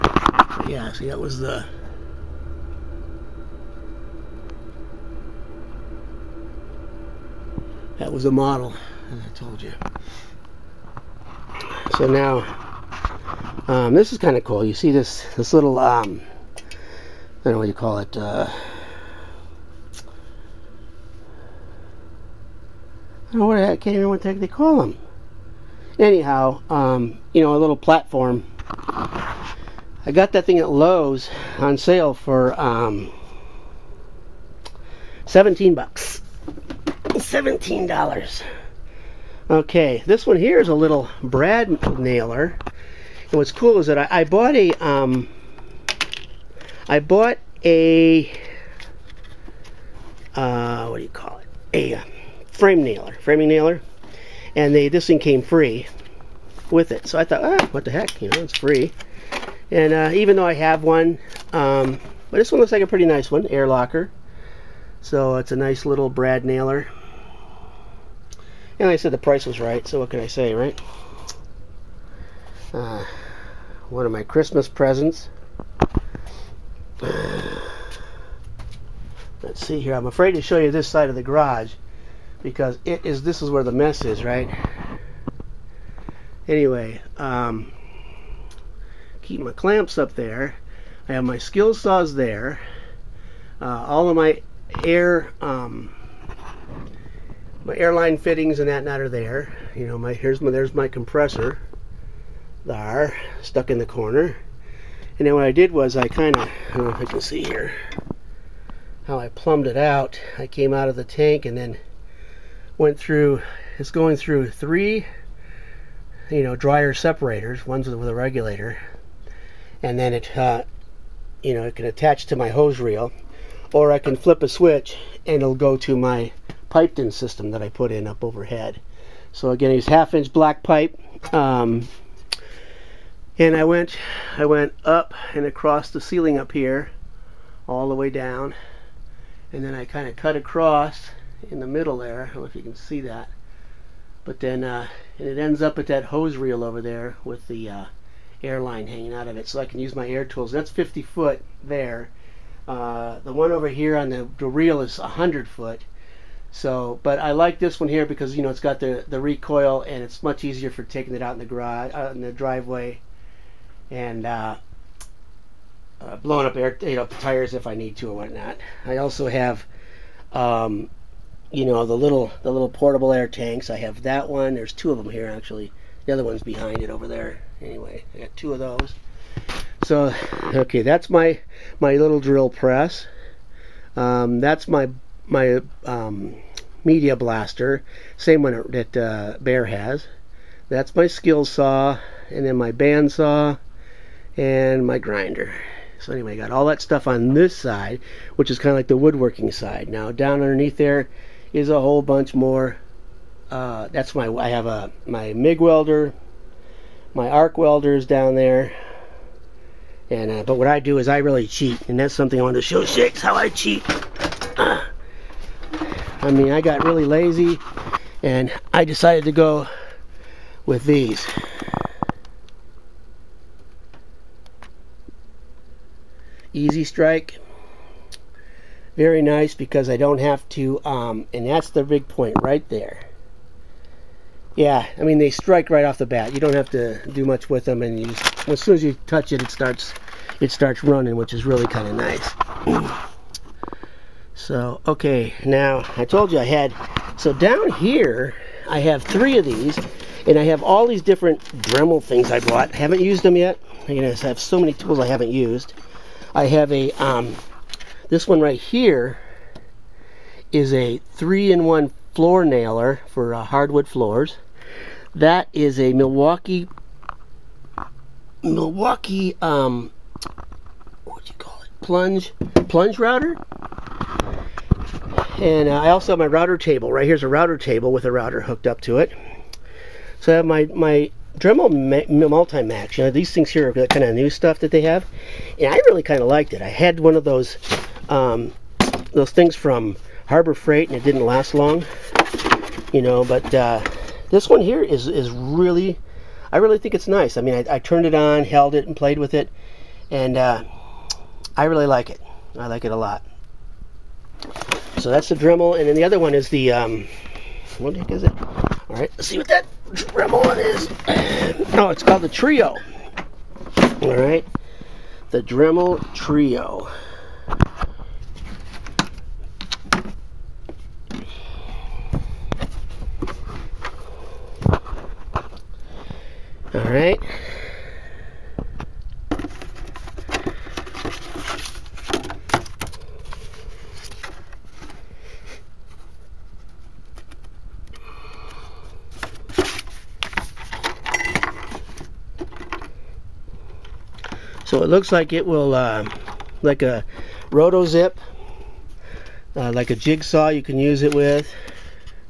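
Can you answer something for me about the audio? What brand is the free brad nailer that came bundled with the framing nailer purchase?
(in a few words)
Air Locker.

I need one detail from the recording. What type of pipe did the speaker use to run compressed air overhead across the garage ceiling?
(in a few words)
half inch black pipe.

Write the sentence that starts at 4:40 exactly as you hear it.
So I have my, my Dremel Multi-Max.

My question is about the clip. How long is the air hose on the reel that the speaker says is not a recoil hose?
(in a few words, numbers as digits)
100 feet.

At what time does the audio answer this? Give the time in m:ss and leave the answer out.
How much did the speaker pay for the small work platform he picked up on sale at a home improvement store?
0:35.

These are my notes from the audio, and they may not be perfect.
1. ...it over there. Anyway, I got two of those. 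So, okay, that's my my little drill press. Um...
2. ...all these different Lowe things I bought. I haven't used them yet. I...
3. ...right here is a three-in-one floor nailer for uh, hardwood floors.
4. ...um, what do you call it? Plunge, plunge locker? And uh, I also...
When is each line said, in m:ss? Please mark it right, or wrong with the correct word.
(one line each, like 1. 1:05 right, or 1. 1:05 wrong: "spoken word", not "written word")
1. 2:56 right
2. 4:10 wrong: "Dremel", not "Lowe"
3. 4:18 right
4. 4:29 wrong: "router", not "locker".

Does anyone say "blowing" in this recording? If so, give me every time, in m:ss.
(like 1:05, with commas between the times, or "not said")
2:46.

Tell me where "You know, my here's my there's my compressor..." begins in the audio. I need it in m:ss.
1:39.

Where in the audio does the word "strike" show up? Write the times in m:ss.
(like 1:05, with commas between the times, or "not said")
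3:46, 3:55.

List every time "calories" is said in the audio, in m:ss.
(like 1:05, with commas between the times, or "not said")
not said.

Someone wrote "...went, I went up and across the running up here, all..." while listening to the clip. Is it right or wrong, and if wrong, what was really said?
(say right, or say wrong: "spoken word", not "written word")
wrong: "ceiling", not "running".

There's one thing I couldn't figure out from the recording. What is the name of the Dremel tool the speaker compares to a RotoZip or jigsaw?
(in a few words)
Dremel Trio.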